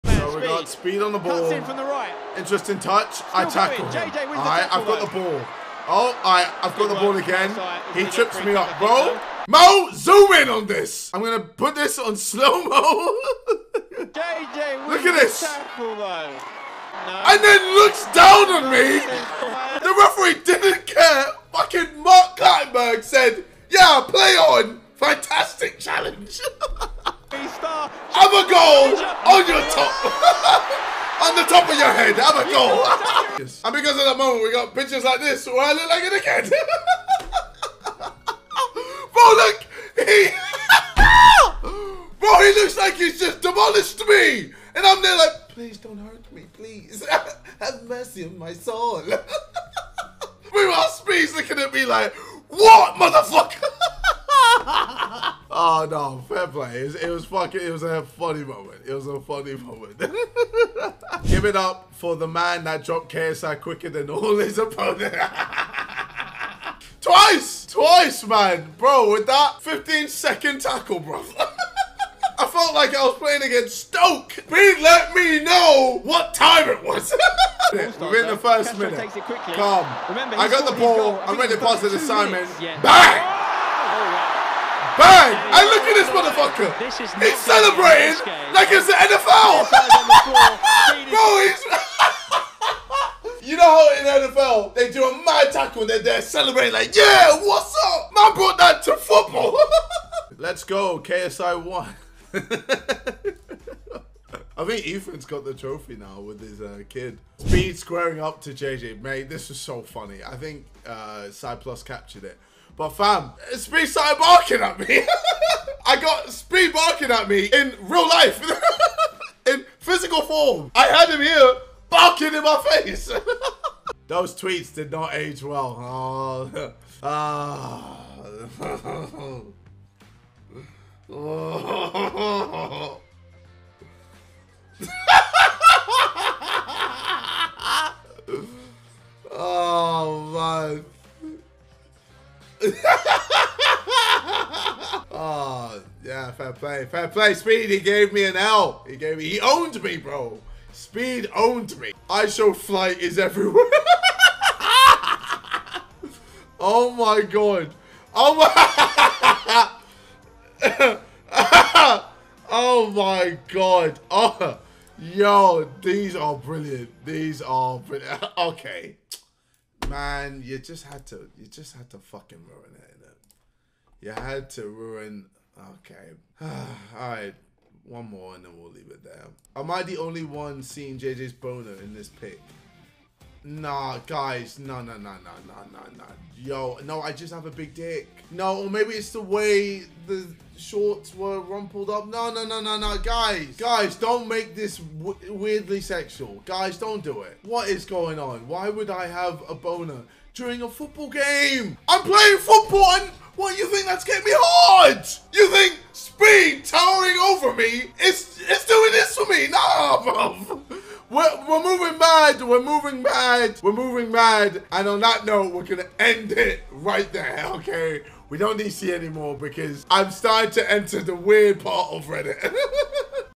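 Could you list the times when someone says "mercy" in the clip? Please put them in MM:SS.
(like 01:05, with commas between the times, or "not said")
00:47.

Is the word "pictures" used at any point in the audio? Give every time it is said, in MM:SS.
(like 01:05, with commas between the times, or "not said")
00:34.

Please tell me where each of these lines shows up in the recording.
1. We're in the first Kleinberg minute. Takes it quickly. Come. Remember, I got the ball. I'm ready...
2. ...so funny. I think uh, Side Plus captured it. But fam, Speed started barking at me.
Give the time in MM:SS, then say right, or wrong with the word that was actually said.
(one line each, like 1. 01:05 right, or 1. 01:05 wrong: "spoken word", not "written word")
1. 01:17 wrong: "Castro", not "Kleinberg"
2. 01:49 right.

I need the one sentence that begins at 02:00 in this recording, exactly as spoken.
I had him here barking in my face.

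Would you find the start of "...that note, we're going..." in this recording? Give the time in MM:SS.
03:35.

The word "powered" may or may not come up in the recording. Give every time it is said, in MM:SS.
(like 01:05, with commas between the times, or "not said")
not said.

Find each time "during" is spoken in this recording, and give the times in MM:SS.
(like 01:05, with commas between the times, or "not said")
03:20.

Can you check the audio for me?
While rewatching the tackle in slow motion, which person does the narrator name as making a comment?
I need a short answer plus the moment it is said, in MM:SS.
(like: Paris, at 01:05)
Mark Kleinberg, at 00:22.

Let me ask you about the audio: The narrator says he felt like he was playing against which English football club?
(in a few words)
Stoke.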